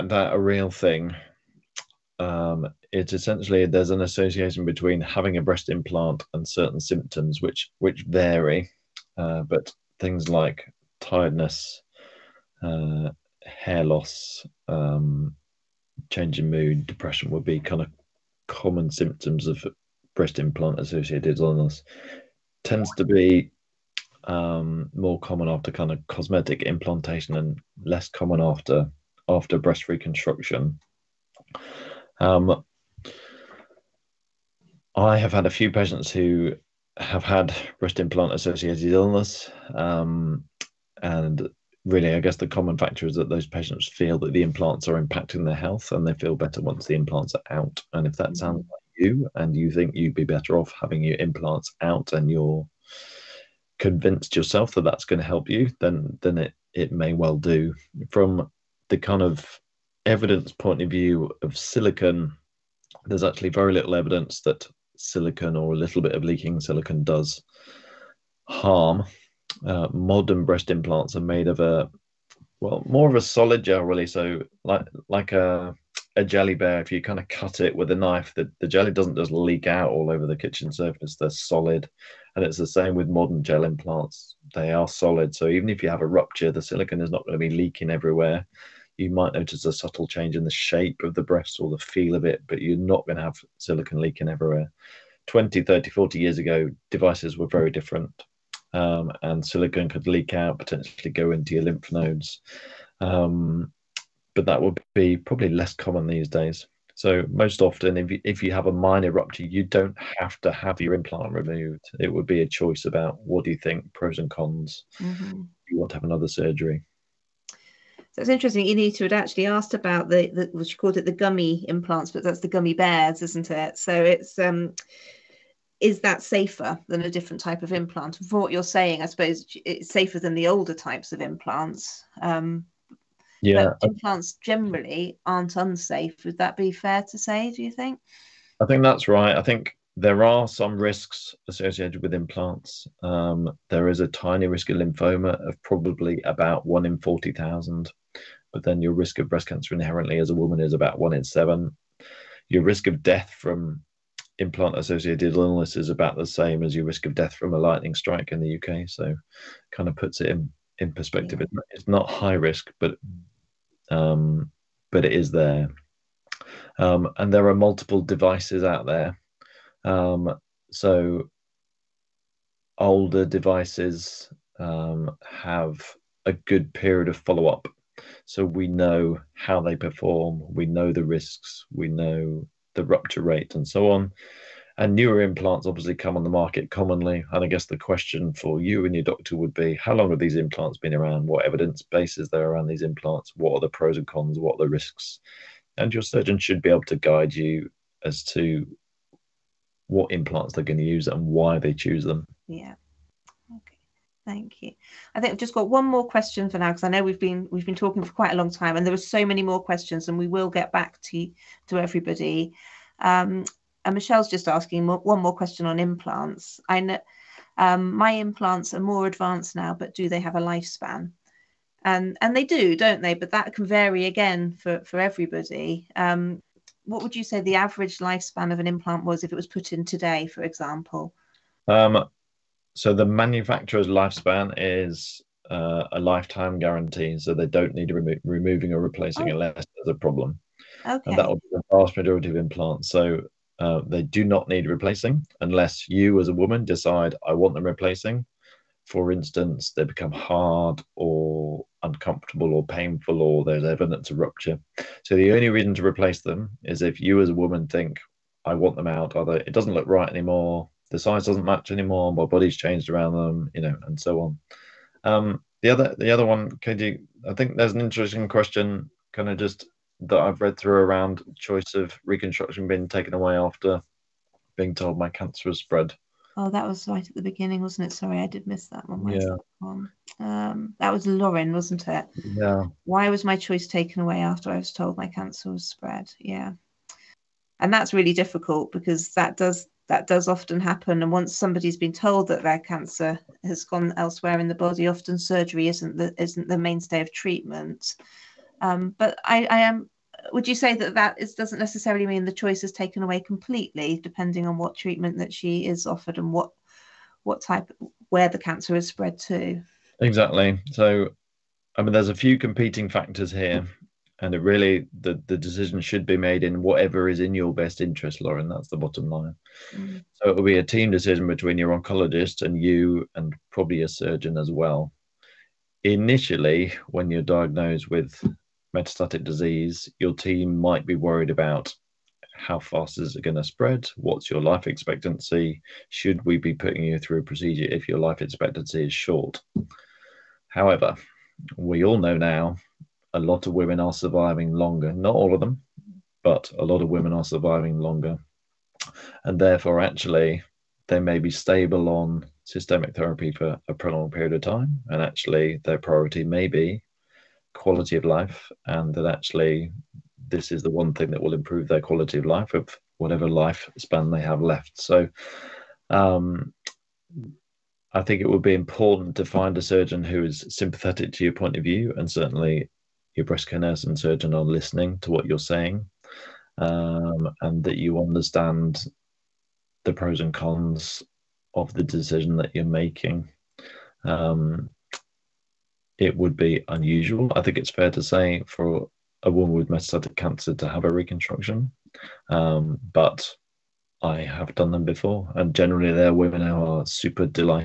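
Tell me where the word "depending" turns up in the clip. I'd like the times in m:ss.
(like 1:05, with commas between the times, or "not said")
5:04.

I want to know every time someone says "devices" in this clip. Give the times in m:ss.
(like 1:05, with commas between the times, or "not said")
1:36, 2:48, 2:53.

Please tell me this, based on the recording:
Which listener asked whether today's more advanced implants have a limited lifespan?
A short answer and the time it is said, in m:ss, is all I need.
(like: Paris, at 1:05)
Michelle, at 3:33.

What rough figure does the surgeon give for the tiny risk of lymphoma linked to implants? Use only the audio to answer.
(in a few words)
1 in 40,000.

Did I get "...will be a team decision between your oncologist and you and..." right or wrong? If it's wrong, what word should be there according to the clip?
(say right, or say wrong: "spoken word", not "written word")
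right.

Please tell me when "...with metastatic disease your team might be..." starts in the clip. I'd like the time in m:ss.
5:27.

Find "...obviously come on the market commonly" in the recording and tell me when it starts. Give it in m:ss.
3:05.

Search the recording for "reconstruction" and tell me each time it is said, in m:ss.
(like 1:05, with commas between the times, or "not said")
0:29, 4:32, 6:30.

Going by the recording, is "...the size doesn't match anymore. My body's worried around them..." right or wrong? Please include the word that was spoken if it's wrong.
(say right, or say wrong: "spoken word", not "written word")
wrong: "changed", not "worried".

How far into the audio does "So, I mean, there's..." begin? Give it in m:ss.
5:10.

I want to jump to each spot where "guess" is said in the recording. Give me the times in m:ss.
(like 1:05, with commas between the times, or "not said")
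0:42, 3:07.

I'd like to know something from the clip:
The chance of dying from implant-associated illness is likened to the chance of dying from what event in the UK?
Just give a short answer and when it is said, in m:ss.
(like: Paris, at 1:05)
lightning strike, at 2:37.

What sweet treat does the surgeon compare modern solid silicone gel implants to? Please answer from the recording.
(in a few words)
jelly bear.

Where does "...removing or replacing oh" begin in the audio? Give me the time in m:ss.
3:58.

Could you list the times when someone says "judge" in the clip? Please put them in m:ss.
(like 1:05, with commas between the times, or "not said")
not said.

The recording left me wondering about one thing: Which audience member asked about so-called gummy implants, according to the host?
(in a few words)
Anita.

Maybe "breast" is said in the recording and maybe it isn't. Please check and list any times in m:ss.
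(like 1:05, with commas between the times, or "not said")
0:05, 0:20, 0:29, 0:37, 1:10, 1:31, 2:29, 6:13.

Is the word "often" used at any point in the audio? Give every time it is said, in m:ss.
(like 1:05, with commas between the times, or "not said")
1:47, 4:50, 4:54.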